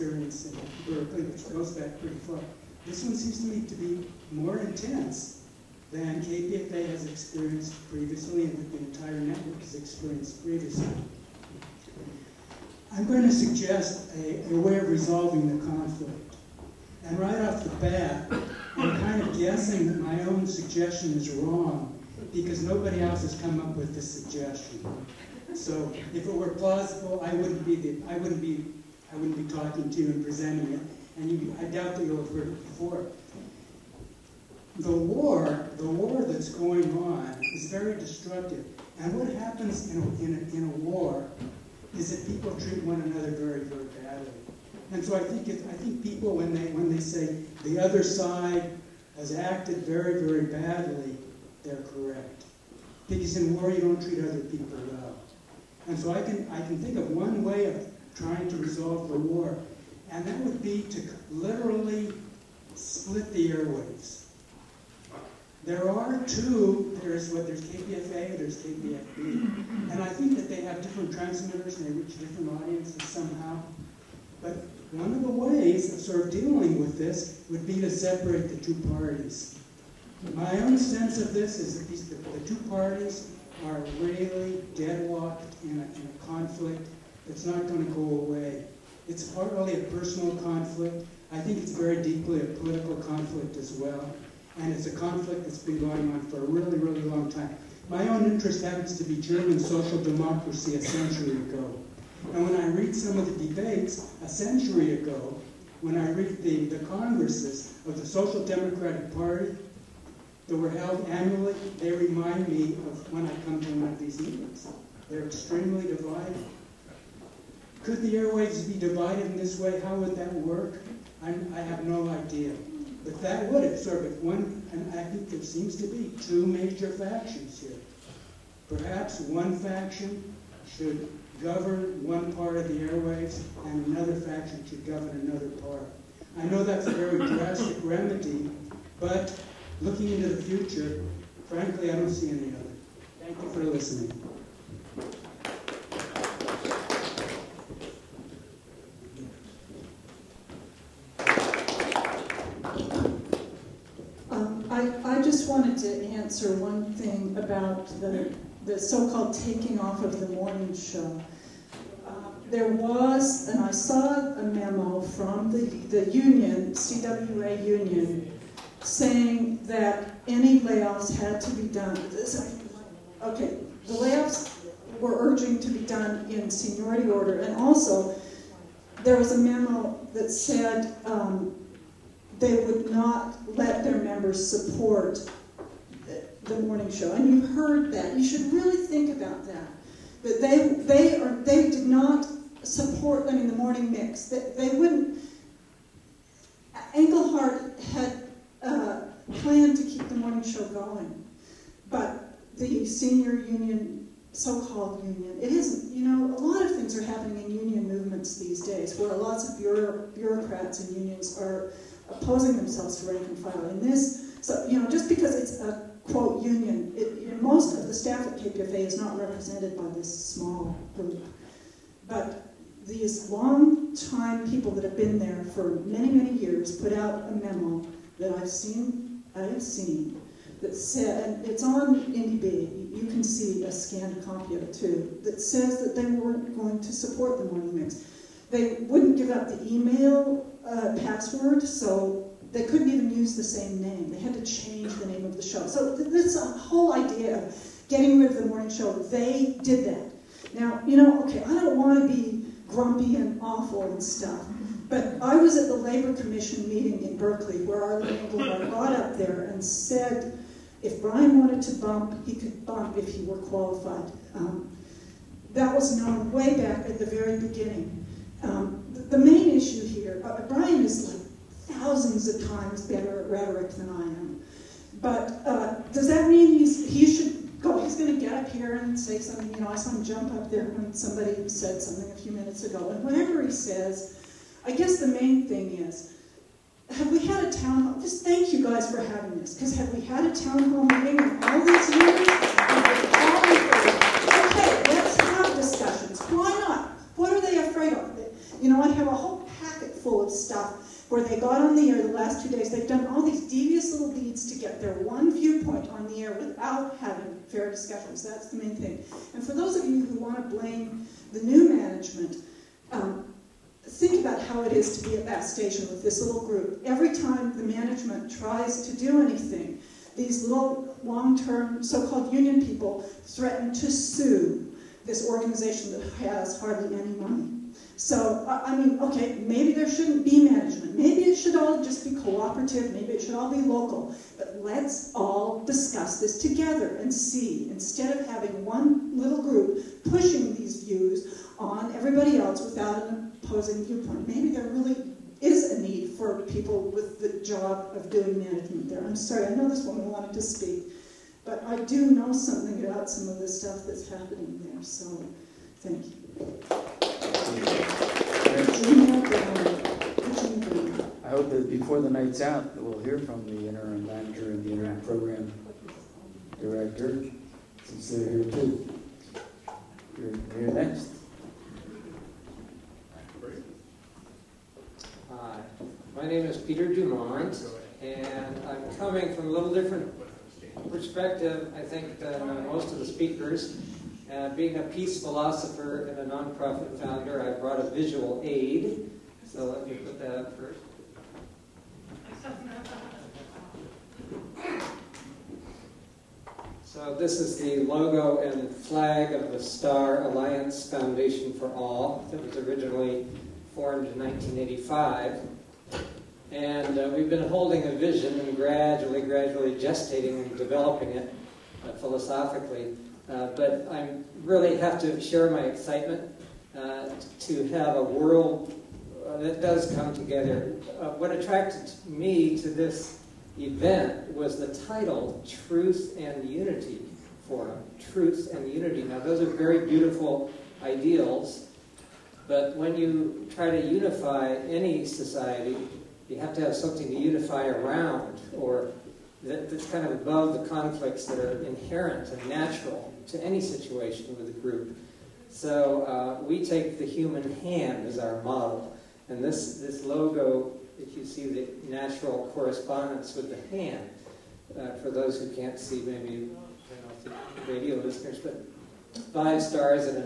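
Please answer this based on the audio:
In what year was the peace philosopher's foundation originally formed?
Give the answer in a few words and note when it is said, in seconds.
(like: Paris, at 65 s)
1985, at 404 s.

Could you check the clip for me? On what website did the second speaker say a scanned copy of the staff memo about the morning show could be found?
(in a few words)
Indybay.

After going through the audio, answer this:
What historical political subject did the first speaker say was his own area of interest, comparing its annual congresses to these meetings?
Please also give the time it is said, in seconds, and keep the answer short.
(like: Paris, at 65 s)
German social democracy, at 99 s.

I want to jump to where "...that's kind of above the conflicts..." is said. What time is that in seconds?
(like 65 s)
439 s.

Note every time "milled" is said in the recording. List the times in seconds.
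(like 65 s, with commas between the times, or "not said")
not said.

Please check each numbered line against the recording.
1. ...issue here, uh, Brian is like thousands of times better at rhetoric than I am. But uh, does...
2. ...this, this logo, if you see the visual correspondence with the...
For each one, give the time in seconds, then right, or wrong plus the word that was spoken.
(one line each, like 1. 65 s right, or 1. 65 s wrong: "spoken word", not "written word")
1. 269 s right
2. 449 s wrong: "natural", not "visual".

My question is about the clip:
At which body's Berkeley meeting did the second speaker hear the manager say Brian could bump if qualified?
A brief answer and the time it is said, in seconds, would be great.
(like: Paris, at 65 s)
Labor Commission, at 255 s.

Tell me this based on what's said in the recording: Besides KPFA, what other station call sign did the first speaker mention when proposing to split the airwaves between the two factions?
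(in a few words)
KPFB.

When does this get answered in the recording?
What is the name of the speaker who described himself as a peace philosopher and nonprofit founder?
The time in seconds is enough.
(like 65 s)
376 s.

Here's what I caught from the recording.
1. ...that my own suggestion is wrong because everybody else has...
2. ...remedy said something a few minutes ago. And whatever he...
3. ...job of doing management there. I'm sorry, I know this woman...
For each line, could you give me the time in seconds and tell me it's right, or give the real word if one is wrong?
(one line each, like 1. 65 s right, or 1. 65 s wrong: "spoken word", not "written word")
1. 19 s wrong: "nobody", not "everybody"
2. 280 s wrong: "somebody", not "remedy"
3. 347 s right.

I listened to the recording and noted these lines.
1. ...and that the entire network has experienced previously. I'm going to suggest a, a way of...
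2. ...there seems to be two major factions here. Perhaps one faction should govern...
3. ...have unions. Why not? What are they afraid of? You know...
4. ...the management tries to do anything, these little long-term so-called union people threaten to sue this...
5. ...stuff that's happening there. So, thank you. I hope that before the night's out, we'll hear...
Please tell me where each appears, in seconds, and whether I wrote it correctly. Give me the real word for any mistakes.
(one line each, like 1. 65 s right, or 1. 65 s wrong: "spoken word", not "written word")
1. 8 s right
2. 125 s right
3. 295 s wrong: "discussions", not "unions"
4. 317 s right
5. 353 s right.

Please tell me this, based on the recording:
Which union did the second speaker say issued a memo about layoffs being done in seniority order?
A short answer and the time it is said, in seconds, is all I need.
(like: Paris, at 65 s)
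CWA, at 166 s.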